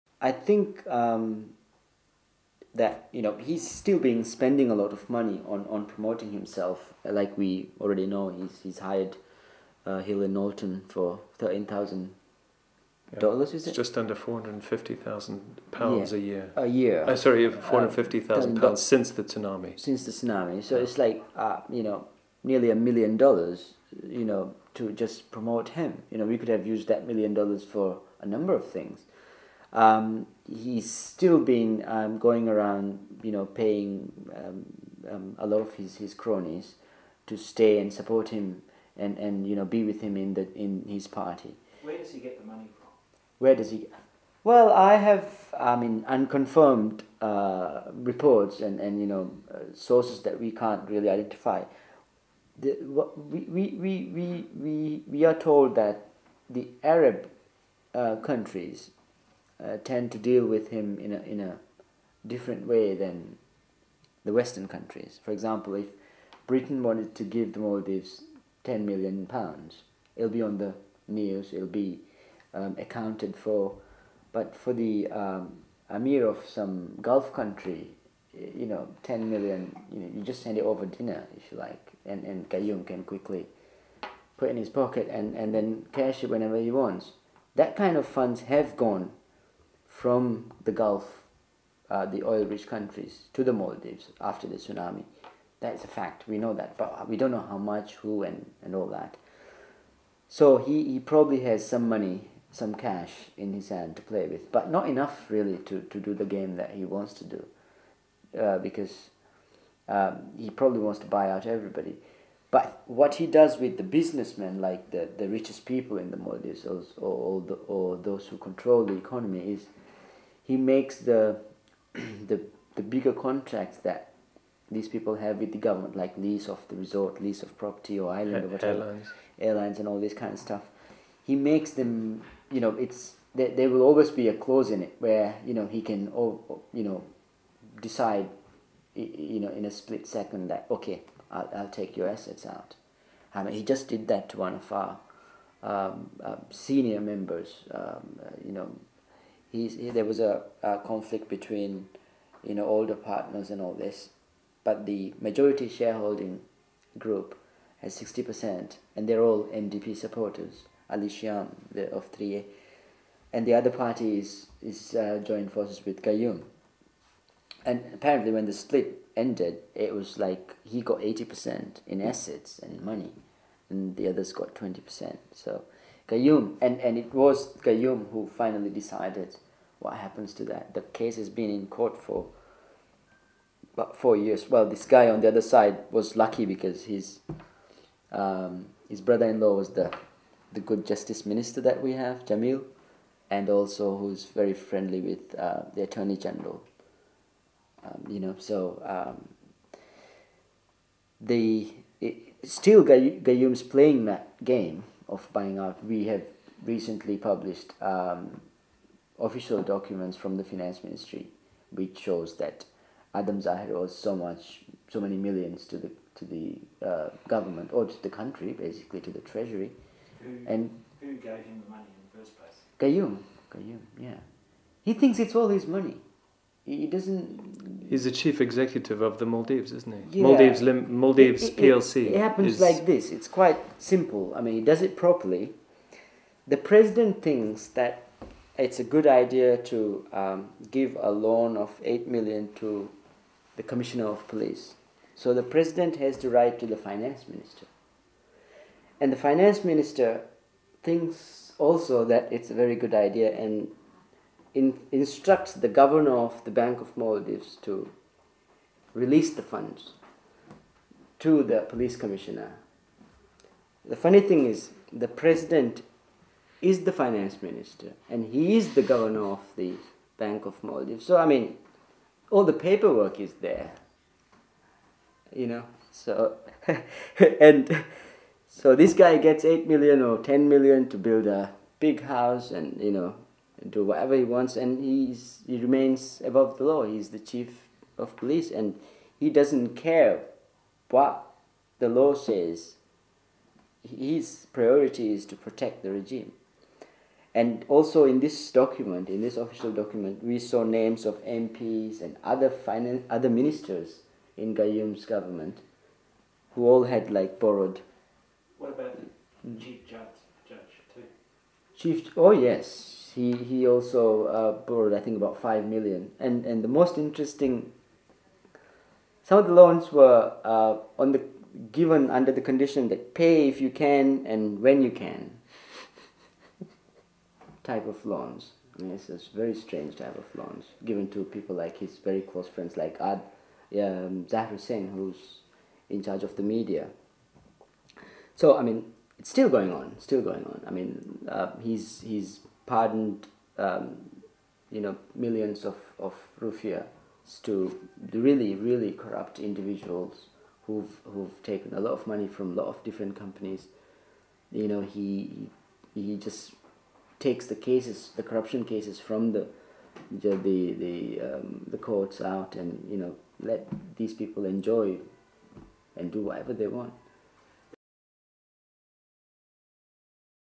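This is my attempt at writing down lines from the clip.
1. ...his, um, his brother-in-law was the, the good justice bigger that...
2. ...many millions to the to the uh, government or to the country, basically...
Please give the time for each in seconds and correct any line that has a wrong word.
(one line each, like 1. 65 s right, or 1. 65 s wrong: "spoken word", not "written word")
1. 186 s wrong: "minister", not "bigger"
2. 215 s right.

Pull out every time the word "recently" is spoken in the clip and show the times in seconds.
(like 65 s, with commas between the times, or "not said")
206 s.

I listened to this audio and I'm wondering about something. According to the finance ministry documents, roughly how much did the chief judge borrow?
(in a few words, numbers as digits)
about 5 million.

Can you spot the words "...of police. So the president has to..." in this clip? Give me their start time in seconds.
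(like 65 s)
244 s.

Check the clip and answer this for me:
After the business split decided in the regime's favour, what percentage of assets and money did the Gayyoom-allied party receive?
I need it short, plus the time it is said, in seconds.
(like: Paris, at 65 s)
80%, at 170 s.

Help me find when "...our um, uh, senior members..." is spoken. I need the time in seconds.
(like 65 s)
144 s.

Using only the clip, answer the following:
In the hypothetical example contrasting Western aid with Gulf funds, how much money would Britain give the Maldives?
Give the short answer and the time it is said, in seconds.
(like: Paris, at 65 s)
10 million pounds, at 68 s.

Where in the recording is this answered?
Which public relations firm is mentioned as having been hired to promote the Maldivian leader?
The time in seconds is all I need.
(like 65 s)
9 s.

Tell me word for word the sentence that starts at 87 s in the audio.
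That kind of funds have gone from the Gulf, uh, the oil rich countries, to the Maldives after the tsunami.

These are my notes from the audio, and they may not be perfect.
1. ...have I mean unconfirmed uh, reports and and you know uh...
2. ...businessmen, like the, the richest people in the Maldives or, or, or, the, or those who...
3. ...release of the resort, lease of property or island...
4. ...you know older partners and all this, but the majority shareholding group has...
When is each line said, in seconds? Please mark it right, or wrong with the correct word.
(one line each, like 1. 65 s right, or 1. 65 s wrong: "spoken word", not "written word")
1. 44 s right
2. 113 s right
3. 126 s wrong: "lease", not "release"
4. 152 s right.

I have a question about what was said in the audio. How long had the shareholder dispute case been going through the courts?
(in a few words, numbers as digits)
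about four years.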